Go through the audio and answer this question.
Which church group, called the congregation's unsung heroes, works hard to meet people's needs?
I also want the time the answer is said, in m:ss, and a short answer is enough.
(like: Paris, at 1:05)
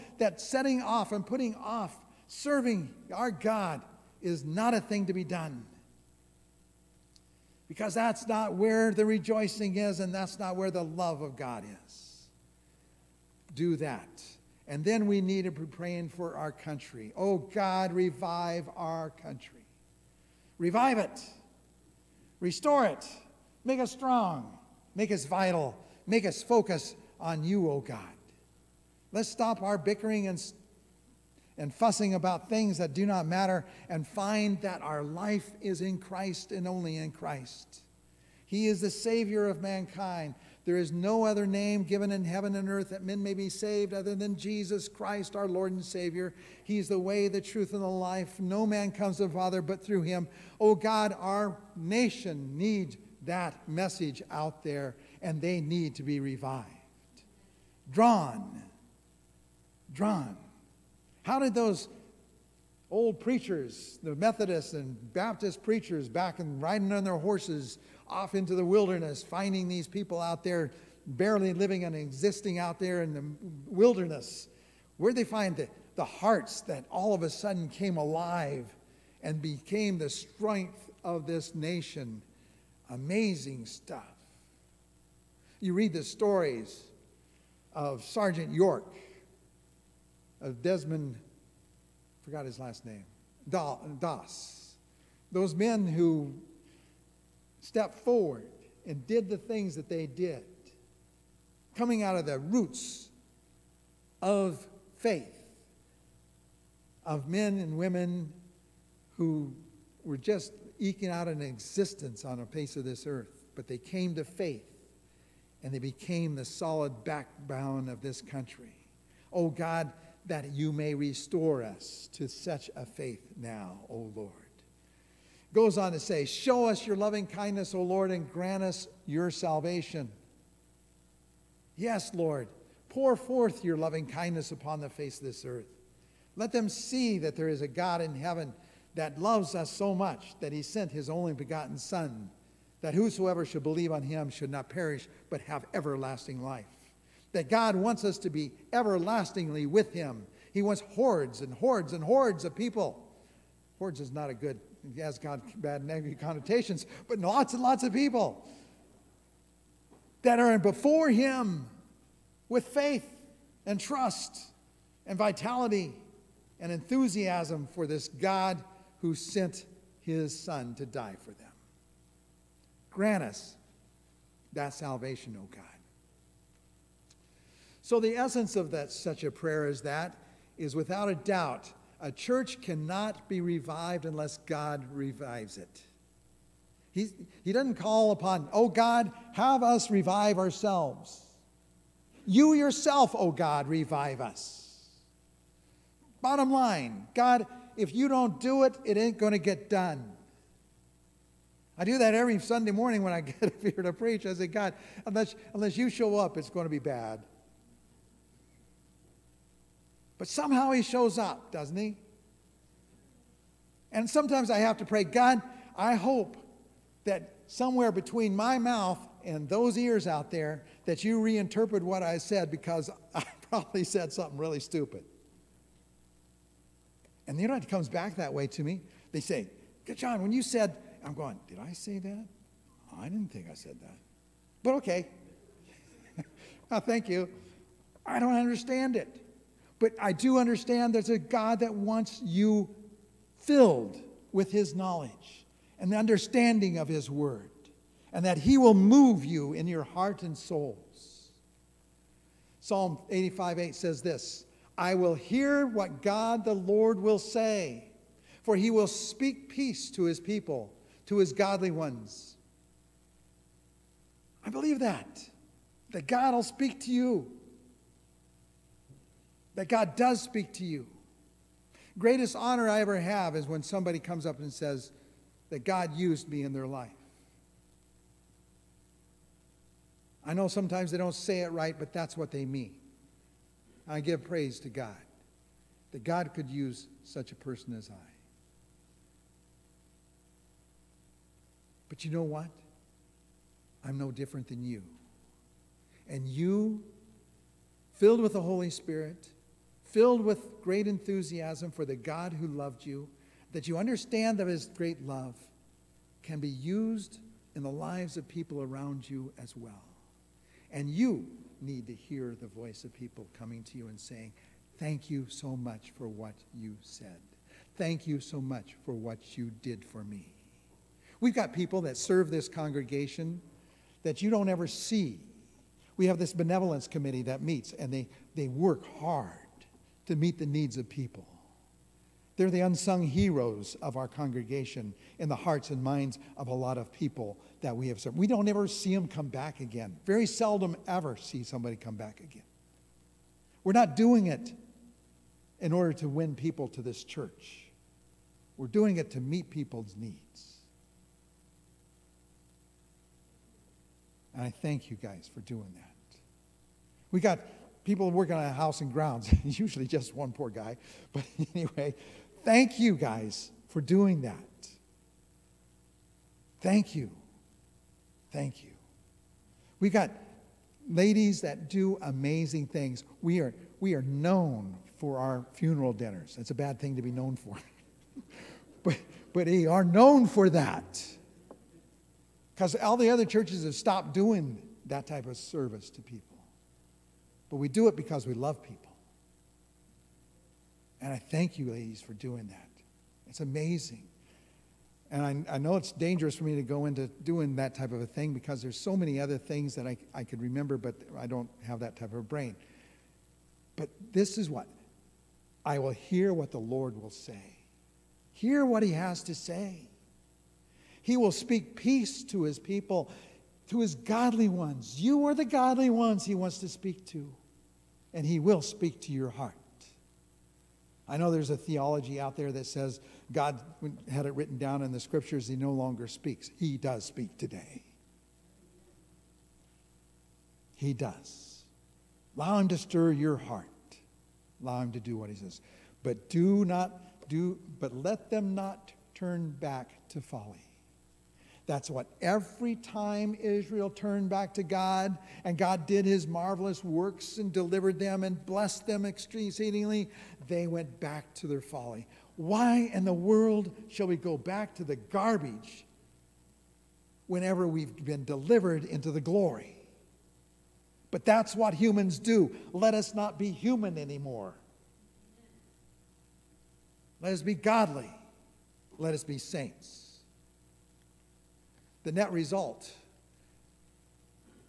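Benevolence committee, at 5:26.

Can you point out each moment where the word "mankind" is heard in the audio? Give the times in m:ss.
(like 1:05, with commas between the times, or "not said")
0:39.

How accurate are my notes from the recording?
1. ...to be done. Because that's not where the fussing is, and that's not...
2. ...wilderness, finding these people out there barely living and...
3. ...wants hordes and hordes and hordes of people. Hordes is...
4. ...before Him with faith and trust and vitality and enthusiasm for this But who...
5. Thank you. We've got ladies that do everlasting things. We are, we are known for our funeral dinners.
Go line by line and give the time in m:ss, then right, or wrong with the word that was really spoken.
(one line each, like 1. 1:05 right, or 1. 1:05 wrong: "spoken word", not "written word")
1. 0:05 wrong: "rejoicing", not "fussing"
2. 1:08 right
3. 2:30 right
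4. 2:40 wrong: "God", not "But"
5. 6:08 wrong: "amazing", not "everlasting".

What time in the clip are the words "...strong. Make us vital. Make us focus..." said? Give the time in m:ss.
0:23.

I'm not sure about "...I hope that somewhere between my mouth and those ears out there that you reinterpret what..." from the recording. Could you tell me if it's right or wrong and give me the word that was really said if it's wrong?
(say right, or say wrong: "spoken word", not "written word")
right.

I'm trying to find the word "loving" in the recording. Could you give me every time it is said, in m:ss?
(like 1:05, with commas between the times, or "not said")
2:06, 2:13.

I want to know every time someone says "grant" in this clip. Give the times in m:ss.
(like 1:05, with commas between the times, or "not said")
2:08, 2:52.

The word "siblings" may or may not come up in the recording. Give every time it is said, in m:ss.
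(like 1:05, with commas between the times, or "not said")
not said.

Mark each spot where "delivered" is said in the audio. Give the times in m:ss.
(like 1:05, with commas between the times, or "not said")
7:27, 7:38.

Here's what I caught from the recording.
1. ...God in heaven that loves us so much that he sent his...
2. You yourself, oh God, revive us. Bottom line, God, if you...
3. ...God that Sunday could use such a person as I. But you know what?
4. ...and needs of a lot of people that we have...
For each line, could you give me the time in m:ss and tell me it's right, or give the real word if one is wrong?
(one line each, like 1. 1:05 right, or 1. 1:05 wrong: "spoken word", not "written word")
1. 2:17 right
2. 3:12 right
3. 4:44 wrong: "God", not "Sunday"
4. 5:35 wrong: "minds", not "needs".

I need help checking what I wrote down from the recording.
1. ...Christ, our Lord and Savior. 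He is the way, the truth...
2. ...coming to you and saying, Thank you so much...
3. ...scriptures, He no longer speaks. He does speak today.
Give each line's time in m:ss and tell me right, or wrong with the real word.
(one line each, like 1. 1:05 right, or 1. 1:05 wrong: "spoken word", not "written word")
1. 0:44 right
2. 5:13 right
3. 7:05 right.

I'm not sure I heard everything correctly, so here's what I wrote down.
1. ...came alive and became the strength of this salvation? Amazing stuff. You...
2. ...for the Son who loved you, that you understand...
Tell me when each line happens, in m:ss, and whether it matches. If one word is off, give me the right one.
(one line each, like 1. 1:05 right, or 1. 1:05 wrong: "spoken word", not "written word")
1. 1:17 wrong: "nation", not "salvation"
2. 5:01 wrong: "God", not "Son".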